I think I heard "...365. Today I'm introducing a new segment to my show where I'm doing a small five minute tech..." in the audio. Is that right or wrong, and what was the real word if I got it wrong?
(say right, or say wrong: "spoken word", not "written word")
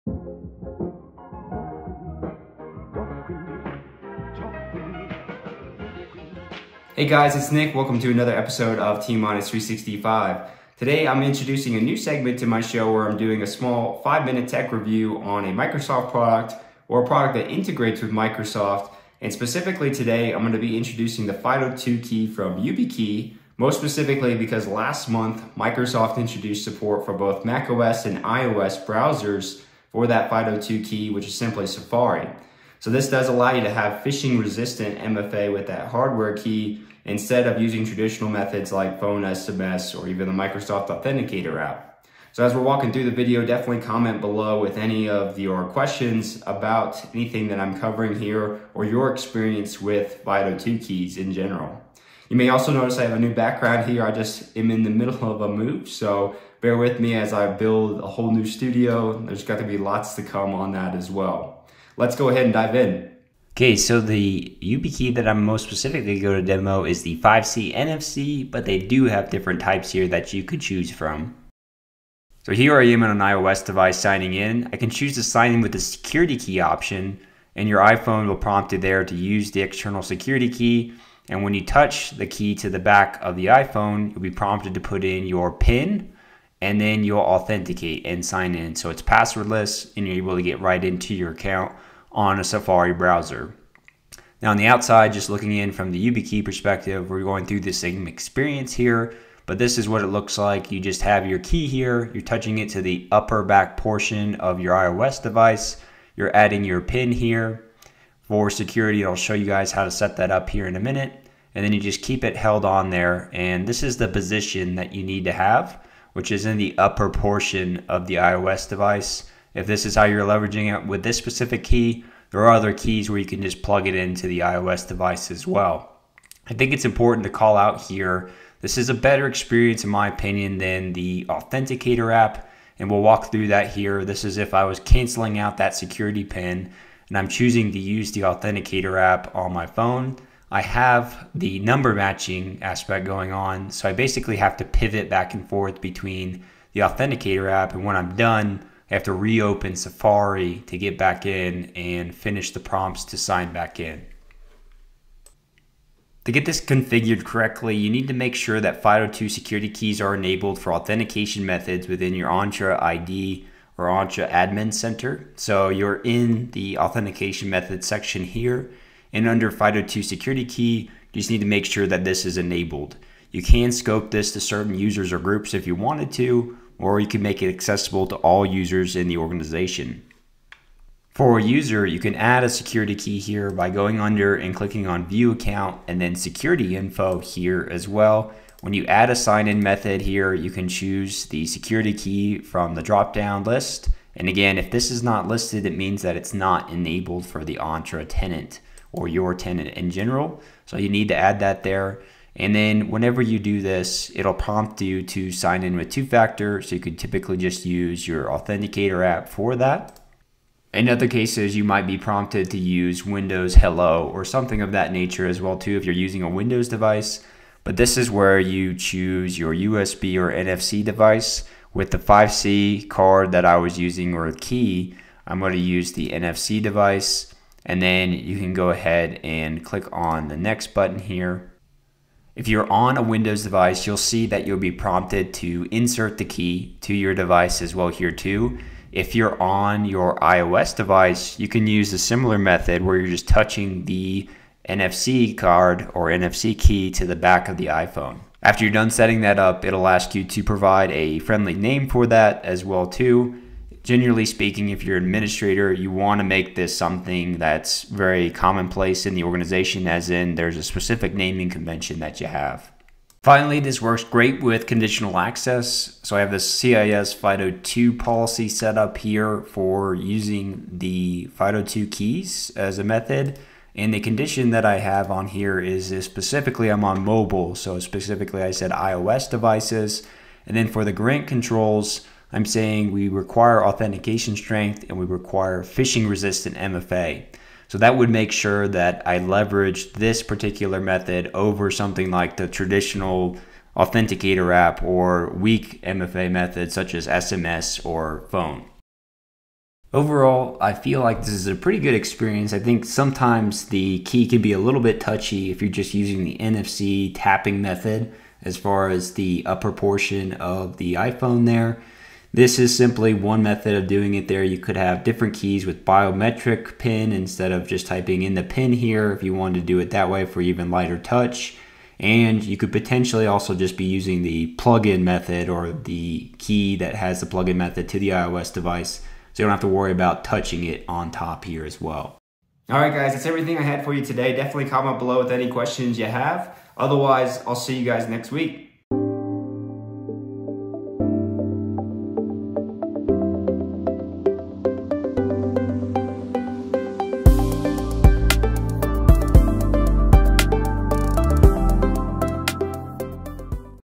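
right.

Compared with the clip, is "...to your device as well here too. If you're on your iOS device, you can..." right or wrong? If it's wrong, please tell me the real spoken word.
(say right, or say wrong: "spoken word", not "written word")
right.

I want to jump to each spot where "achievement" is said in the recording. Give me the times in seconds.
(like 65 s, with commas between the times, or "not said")
not said.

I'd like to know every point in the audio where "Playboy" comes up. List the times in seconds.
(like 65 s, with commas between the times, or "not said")
not said.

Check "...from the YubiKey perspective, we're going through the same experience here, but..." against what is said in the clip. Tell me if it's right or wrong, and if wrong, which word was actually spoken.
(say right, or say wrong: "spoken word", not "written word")
right.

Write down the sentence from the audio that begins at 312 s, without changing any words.
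This is simply one method of doing it there.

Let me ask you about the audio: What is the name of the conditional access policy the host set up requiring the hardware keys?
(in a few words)
CIS FIDO2.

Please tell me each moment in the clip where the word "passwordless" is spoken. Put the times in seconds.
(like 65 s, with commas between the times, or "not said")
89 s.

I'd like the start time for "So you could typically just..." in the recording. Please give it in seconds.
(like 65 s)
206 s.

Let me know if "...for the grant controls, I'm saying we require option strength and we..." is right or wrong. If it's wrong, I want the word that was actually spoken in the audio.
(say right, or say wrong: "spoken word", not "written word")
wrong: "authentication", not "option".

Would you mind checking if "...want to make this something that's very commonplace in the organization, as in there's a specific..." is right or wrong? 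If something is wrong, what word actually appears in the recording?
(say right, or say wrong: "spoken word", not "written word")
right.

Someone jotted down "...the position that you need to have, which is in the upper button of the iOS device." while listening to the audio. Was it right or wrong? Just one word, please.
wrong.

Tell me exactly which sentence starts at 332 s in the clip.
All right, guys, that's everything I had for you today.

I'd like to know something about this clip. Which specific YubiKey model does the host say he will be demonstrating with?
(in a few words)
5C NFC.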